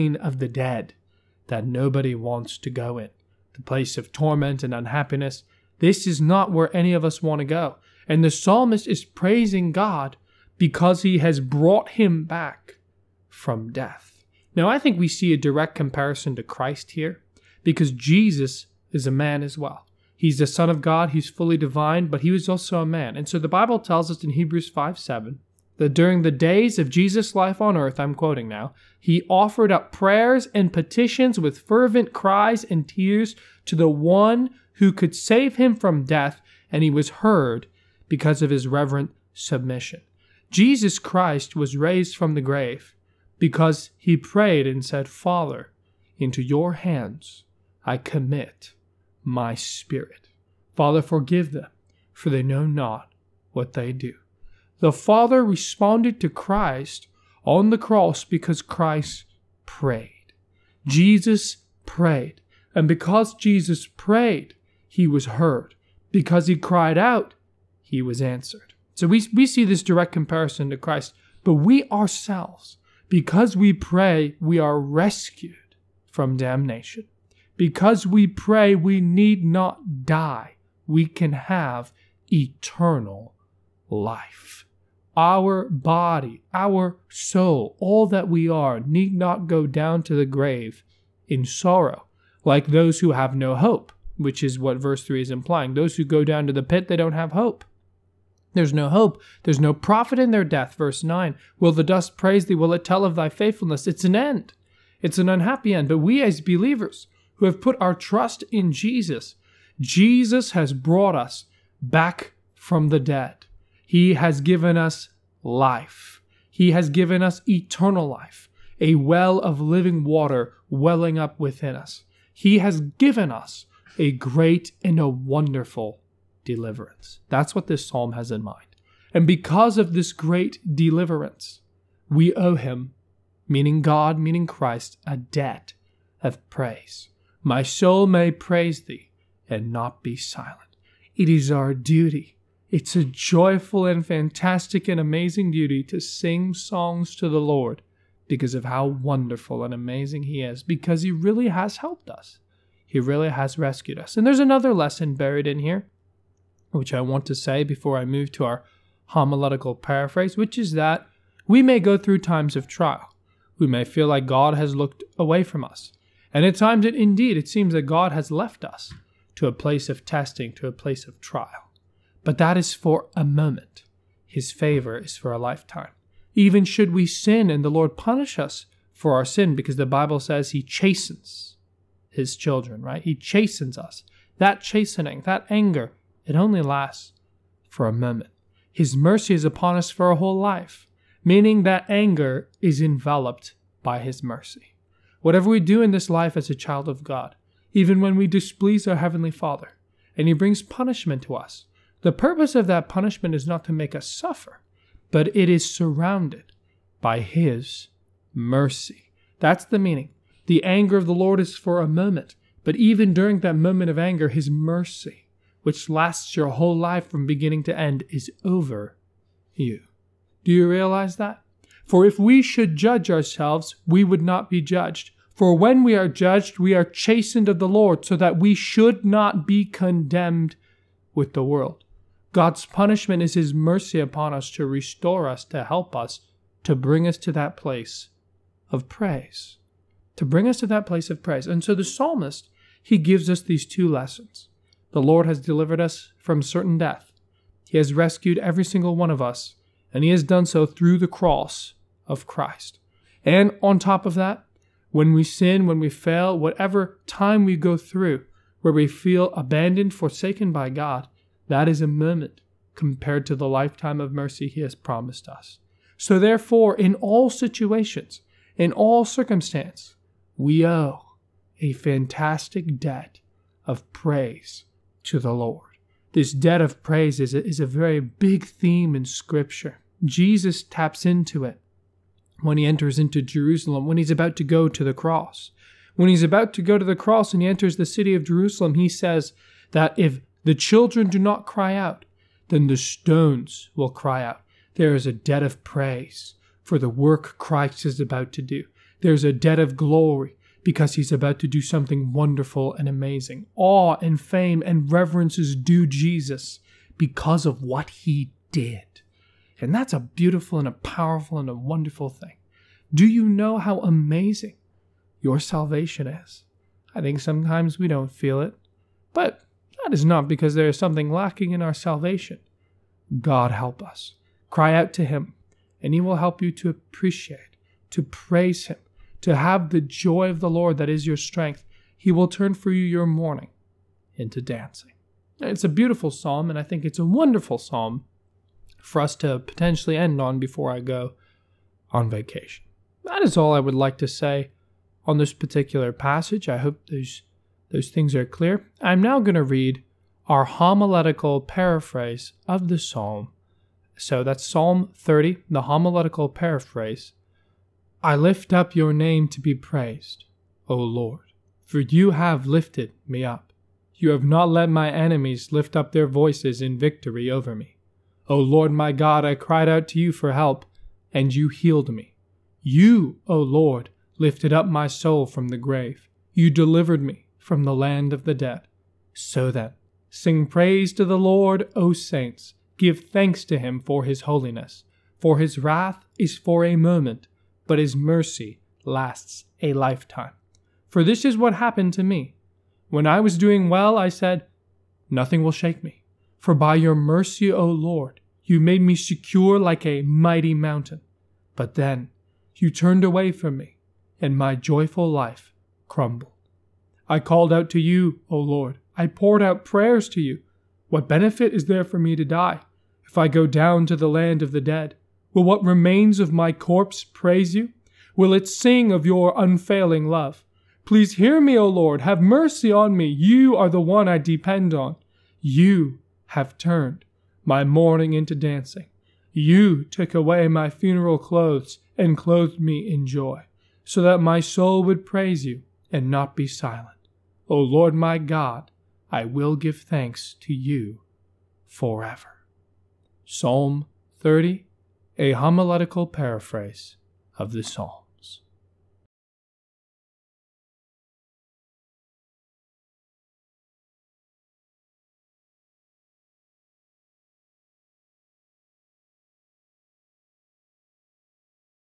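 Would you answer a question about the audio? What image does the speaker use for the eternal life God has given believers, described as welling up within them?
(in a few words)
a well of living water.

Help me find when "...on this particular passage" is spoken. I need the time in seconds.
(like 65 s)
345 s.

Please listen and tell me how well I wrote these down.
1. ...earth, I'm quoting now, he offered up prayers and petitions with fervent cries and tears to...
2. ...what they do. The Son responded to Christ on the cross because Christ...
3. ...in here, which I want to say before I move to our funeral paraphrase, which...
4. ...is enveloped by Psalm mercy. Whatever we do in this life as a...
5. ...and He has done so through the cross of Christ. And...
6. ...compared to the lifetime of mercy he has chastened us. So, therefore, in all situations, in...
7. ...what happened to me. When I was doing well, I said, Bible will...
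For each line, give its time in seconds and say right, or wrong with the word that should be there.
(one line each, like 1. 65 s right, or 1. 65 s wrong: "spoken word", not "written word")
1. 27 s right
2. 53 s wrong: "Father", not "Son"
3. 155 s wrong: "homiletical", not "funeral"
4. 192 s wrong: "His", not "Psalm"
5. 249 s right
6. 262 s wrong: "promised", not "chastened"
7. 391 s wrong: "Nothing", not "Bible".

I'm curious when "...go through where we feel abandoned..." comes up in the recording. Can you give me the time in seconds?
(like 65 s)
257 s.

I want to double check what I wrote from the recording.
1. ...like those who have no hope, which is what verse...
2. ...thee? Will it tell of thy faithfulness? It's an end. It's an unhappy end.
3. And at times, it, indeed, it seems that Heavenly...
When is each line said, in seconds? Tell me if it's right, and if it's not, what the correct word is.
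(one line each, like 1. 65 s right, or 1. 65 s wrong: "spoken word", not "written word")
1. 92 s right
2. 102 s right
3. 166 s wrong: "God", not "Heavenly".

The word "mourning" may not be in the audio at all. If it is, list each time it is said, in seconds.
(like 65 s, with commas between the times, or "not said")
333 s, 427 s.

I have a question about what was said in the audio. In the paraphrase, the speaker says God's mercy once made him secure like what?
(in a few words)
a mighty mountain.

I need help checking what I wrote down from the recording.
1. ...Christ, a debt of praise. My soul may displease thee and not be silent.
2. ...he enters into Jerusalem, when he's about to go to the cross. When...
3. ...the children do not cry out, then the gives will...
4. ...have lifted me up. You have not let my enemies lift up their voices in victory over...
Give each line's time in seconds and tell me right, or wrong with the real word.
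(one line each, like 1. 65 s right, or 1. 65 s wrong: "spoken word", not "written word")
1. 134 s wrong: "praise", not "displease"
2. 282 s right
3. 290 s wrong: "stones", not "gives"
4. 362 s right.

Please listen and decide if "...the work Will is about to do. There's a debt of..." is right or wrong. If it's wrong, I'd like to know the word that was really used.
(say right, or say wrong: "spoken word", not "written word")
wrong: "Christ", not "Will".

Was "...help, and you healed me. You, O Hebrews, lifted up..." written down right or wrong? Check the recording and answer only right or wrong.
wrong.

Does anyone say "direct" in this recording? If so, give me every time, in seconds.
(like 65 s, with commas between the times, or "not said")
15 s, 69 s.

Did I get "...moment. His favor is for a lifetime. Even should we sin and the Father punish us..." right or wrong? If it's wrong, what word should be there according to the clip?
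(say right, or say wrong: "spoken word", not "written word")
wrong: "Lord", not "Father".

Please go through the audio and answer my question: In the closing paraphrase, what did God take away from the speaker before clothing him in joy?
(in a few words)
funeral clothes.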